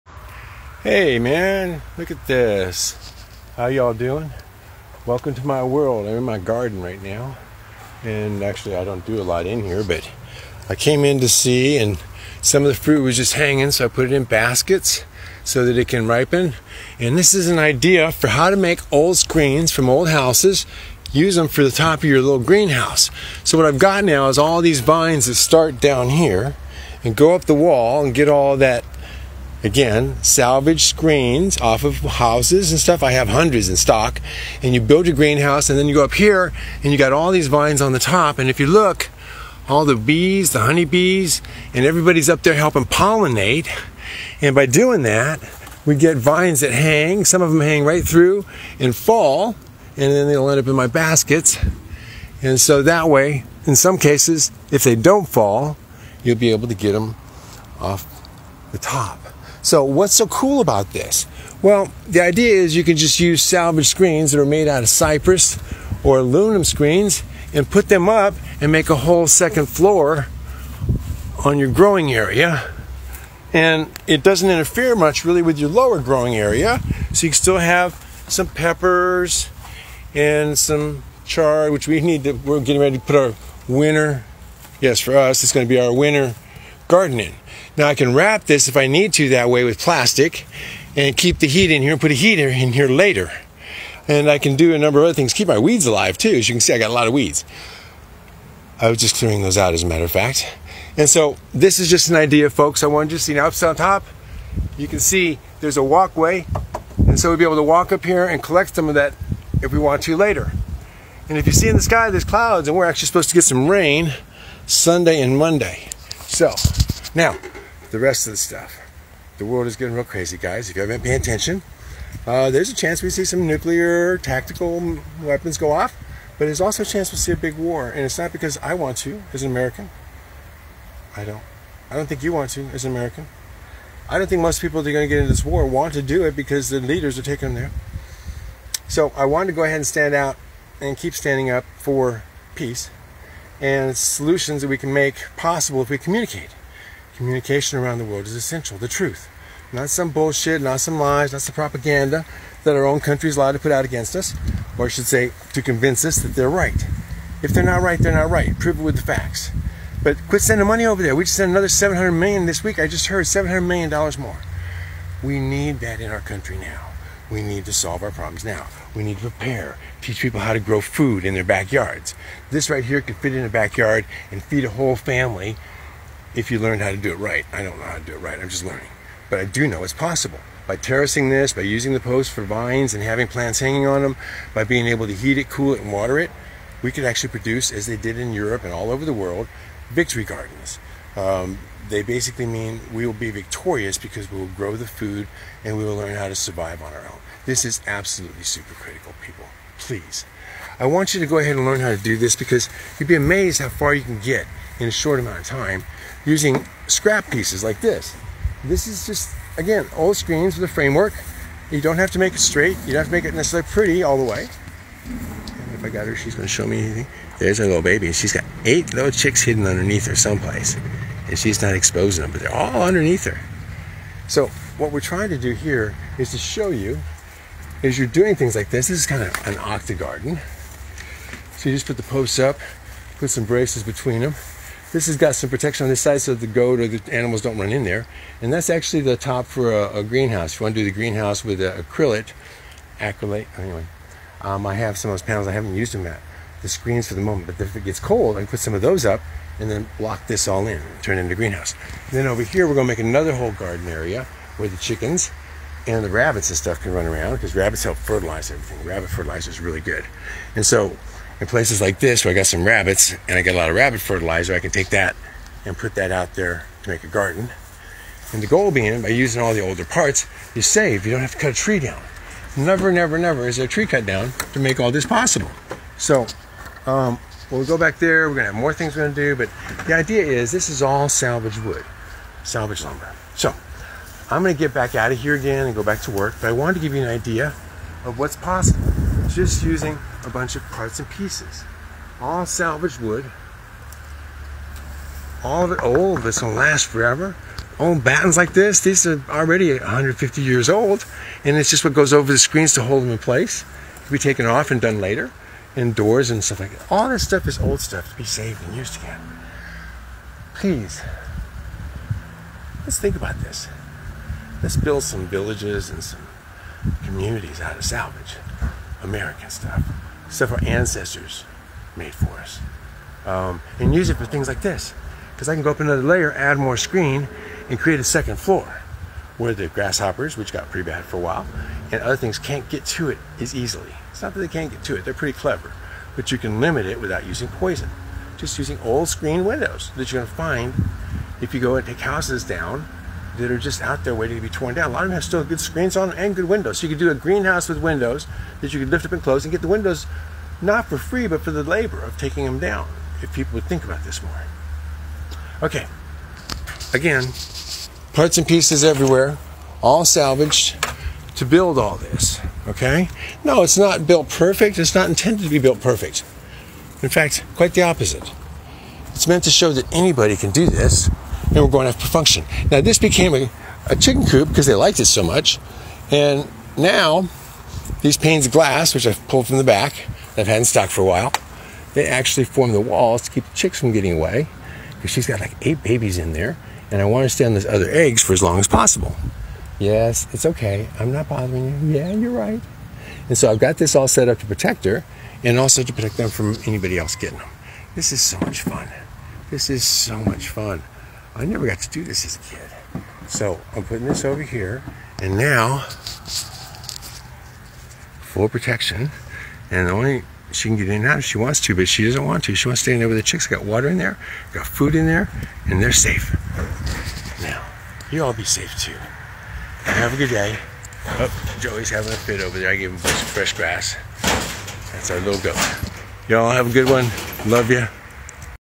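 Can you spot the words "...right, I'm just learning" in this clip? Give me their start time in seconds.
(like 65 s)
178 s.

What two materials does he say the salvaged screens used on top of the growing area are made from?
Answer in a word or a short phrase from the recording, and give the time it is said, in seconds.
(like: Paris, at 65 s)
cypress or aluminum, at 64 s.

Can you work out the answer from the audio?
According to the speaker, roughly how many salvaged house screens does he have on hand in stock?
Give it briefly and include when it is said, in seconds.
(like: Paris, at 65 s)
hundreds, at 33 s.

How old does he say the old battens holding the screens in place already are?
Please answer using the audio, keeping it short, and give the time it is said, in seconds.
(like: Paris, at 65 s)
150 years, at 299 s.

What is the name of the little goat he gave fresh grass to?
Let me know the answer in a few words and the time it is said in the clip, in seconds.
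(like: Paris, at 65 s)
Joey, at 421 s.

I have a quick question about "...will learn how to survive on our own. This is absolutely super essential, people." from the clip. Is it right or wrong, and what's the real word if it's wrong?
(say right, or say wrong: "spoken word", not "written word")
wrong: "critical", not "essential".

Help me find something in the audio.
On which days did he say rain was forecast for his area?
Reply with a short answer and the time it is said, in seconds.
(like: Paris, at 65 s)
Sunday and Monday, at 114 s.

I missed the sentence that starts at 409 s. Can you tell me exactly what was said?
And the only she can get in and out if she wants to, but she doesn't want to.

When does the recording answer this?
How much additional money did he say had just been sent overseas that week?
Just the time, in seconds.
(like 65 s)
163 s.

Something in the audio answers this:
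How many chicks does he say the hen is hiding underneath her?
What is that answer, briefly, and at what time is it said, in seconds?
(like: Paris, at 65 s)
8, at 218 s.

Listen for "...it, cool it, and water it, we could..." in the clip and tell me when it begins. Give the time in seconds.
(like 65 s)
185 s.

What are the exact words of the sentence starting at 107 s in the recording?
And so we'll be able to walk up here and collect some of that if we want to later.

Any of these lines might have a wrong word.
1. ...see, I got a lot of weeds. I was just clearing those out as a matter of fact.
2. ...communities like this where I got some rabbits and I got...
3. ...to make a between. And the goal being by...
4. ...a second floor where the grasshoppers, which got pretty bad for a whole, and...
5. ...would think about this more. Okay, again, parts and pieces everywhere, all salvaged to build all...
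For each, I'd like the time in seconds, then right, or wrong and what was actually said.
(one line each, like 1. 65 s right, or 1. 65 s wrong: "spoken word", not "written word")
1. 96 s right
2. 261 s wrong: "places", not "communities"
3. 266 s wrong: "garden", not "between"
4. 327 s wrong: "while", not "whole"
5. 353 s right.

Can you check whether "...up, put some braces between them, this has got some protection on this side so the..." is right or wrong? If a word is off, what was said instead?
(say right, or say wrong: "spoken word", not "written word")
right.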